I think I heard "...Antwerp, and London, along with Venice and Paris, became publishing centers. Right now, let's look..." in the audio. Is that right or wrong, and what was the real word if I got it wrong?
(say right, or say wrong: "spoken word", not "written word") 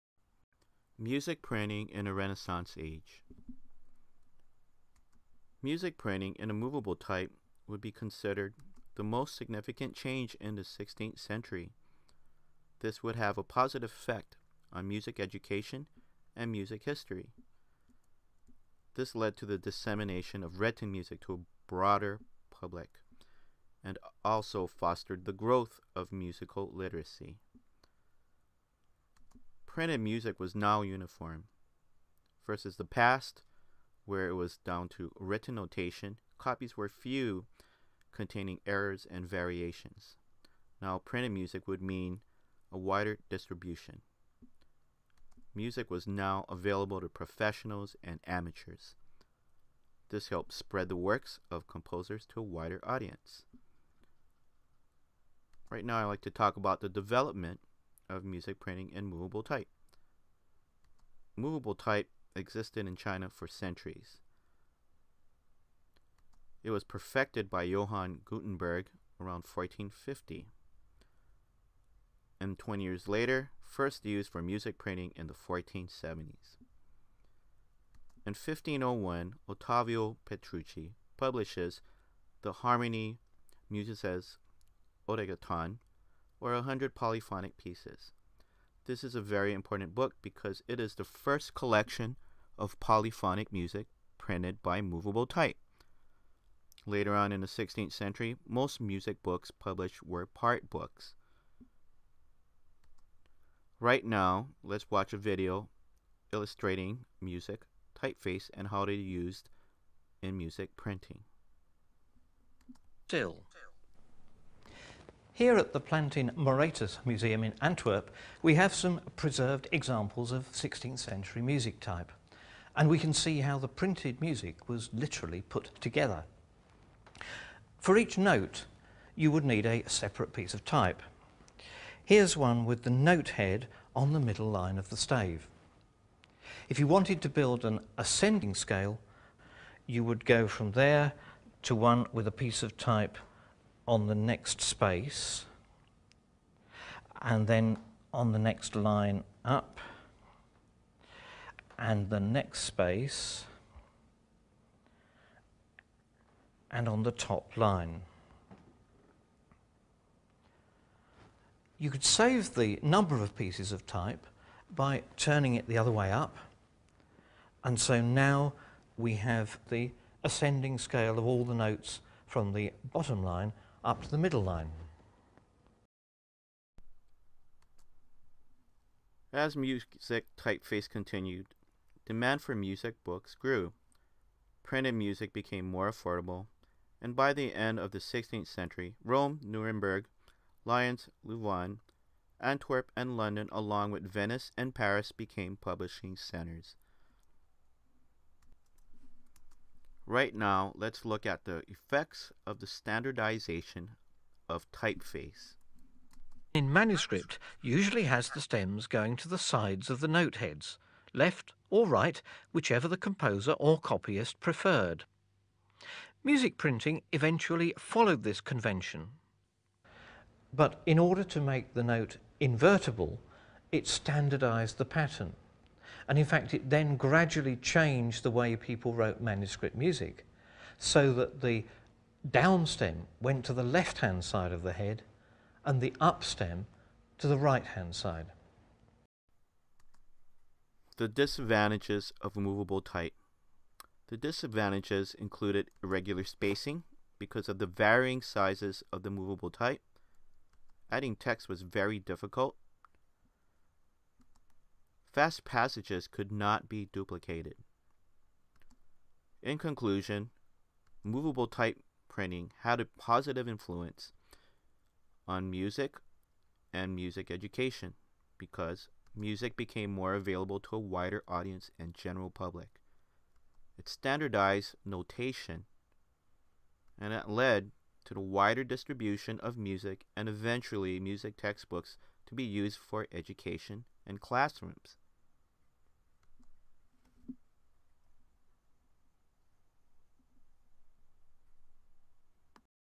right.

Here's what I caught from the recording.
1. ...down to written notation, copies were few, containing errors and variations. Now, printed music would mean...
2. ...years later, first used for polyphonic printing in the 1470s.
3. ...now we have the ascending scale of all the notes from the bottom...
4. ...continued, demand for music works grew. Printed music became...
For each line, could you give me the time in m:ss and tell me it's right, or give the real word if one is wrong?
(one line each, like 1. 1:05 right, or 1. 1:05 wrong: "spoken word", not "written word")
1. 0:34 right
2. 1:12 wrong: "music", not "polyphonic"
3. 2:48 right
4. 3:00 wrong: "books", not "works".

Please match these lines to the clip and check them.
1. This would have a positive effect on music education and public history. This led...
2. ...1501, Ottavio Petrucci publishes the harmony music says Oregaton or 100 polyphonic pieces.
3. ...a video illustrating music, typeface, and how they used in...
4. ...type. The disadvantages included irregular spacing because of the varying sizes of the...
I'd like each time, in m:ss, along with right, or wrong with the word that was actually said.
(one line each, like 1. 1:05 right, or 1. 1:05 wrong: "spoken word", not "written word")
1. 0:12 wrong: "music", not "public"
2. 1:18 right
3. 1:45 right
4. 4:02 right.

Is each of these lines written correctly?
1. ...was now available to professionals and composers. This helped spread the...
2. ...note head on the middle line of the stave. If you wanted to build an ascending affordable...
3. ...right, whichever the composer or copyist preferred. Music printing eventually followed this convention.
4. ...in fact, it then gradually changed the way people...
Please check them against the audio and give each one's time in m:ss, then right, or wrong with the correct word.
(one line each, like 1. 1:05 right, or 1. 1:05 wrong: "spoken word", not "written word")
1. 0:45 wrong: "amateurs", not "composers"
2. 2:12 wrong: "scale", not "affordable"
3. 3:31 right
4. 3:46 right.